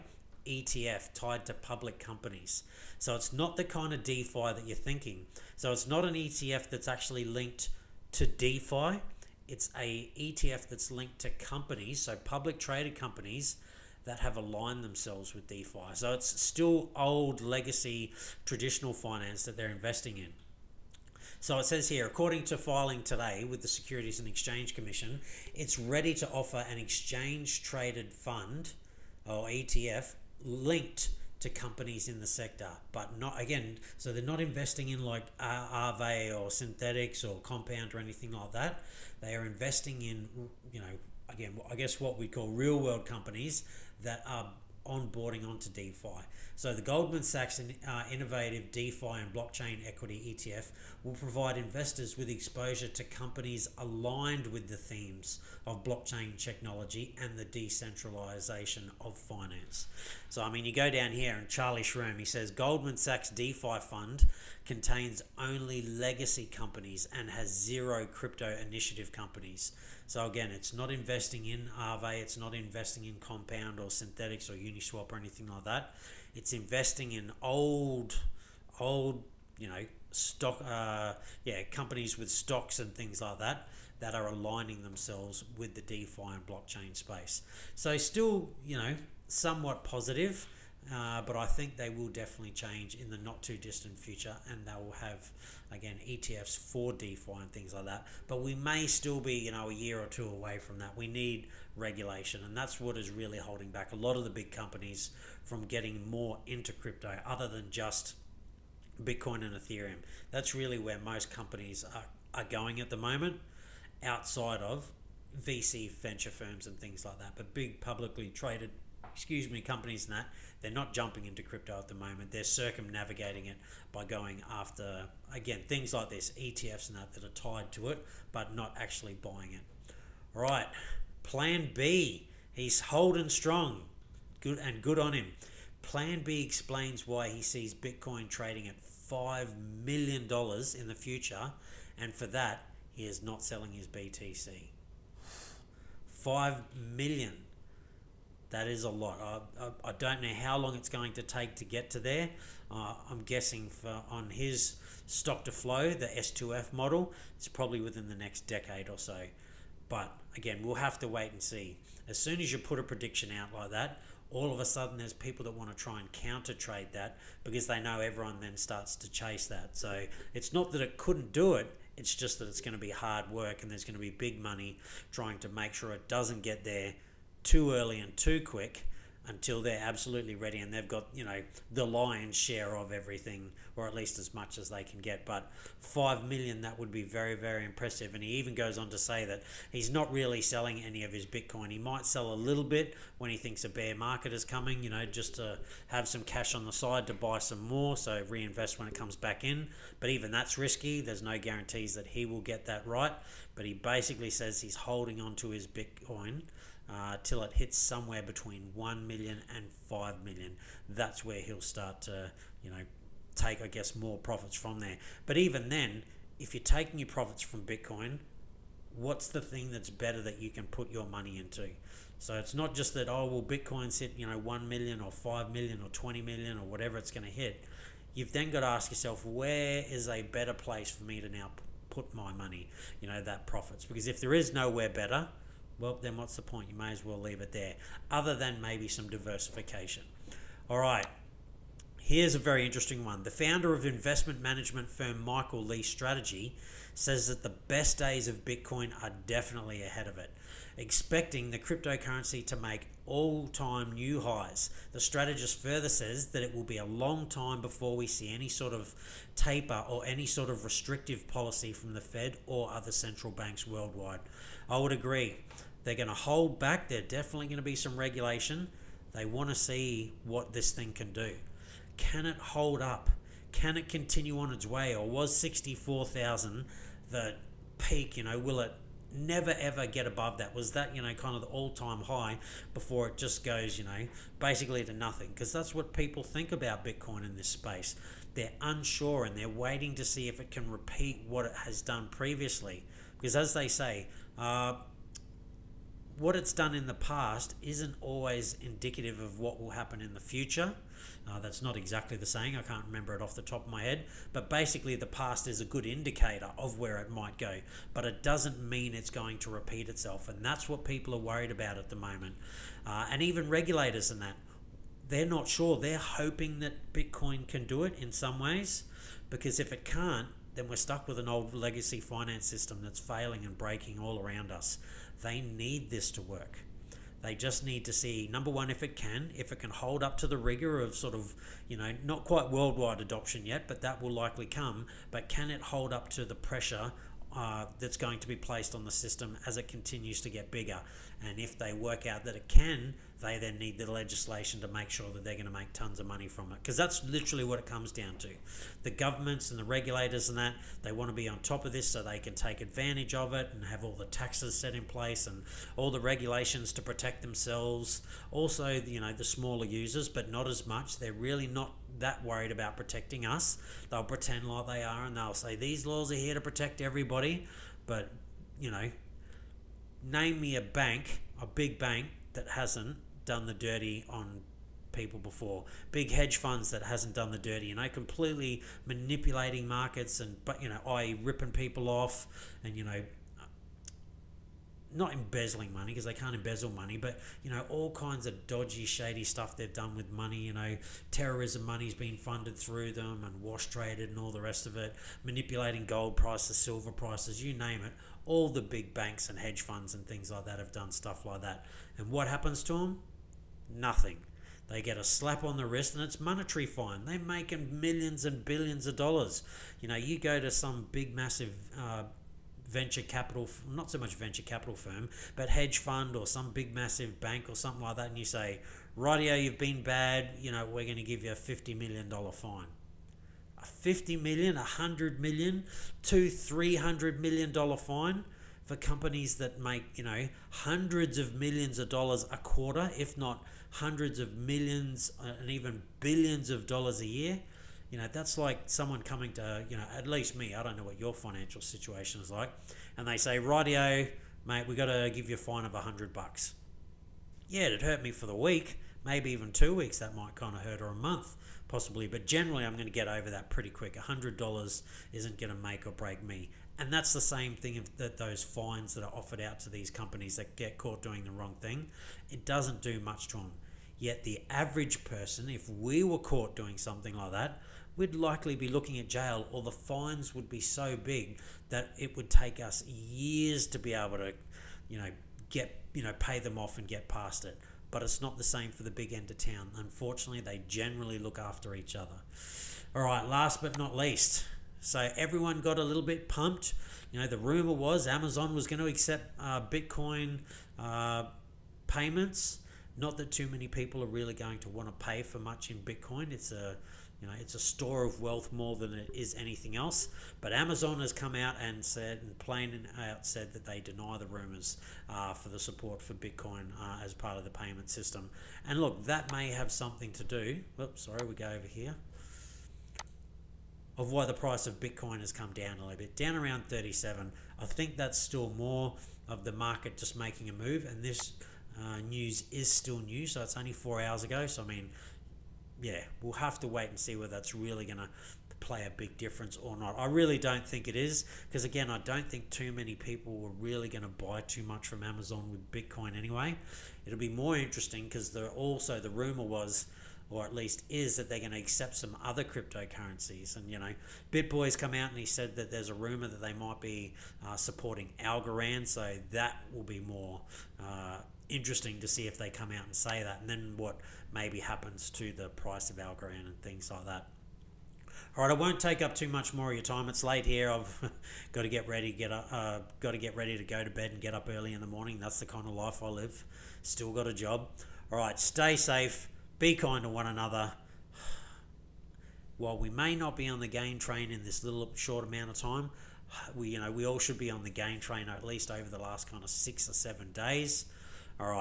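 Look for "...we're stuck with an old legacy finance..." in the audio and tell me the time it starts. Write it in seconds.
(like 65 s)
320 s.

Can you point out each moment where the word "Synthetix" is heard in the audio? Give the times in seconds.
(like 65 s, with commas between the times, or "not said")
36 s, 73 s.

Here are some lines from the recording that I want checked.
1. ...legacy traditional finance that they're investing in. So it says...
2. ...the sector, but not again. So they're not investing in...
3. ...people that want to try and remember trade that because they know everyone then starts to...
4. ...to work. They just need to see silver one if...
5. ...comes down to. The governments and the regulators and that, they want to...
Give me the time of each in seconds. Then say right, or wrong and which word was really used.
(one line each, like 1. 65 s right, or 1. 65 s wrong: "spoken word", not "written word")
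1. 17 s right
2. 32 s right
3. 165 s wrong: "counter", not "remember"
4. 326 s wrong: "number", not "silver"
5. 347 s right.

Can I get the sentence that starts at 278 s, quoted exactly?
You know, will it never ever get above that?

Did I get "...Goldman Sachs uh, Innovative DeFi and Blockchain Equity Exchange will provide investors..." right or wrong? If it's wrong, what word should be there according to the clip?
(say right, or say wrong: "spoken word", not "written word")
wrong: "ETF", not "Exchange".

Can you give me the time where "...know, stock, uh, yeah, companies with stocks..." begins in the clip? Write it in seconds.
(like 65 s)
79 s.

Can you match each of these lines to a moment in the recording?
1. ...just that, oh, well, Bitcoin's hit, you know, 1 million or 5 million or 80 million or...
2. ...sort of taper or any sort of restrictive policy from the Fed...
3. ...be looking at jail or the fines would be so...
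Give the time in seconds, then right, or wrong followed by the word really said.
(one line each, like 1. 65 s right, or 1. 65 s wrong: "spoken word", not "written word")
1. 222 s wrong: "20", not "80"
2. 258 s right
3. 468 s right.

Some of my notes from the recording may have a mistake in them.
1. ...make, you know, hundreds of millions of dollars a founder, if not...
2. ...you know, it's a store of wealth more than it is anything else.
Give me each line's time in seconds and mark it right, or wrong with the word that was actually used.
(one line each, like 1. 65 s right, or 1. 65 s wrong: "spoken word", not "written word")
1. 429 s wrong: "quarter", not "founder"
2. 497 s right.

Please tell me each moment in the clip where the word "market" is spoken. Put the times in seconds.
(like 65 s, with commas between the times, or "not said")
193 s, 379 s, 519 s.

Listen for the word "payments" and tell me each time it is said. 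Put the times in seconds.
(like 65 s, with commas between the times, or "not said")
491 s, 507 s.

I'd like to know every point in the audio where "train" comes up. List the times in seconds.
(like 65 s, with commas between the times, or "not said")
573 s, 577 s.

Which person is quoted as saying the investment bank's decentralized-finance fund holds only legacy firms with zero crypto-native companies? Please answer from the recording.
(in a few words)
Charlie Shrem.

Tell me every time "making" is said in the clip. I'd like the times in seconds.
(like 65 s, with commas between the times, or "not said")
407 s, 520 s.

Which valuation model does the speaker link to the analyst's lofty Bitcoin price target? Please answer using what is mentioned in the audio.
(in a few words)
S2F.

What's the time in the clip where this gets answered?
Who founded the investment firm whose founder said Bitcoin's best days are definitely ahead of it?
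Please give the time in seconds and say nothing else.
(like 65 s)
245 s.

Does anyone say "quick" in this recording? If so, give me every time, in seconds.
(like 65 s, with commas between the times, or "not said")
178 s, 453 s.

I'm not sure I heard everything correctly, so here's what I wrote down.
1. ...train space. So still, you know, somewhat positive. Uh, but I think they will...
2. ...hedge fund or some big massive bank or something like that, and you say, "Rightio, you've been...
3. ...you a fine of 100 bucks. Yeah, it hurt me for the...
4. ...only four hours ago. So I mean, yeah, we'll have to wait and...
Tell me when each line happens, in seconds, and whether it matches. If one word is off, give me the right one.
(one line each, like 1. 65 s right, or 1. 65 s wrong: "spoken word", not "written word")
1. 86 s wrong: "blockchain", not "train"
2. 415 s right
3. 445 s right
4. 523 s right.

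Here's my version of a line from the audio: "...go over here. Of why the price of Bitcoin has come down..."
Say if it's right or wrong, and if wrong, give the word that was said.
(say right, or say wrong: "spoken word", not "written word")
right.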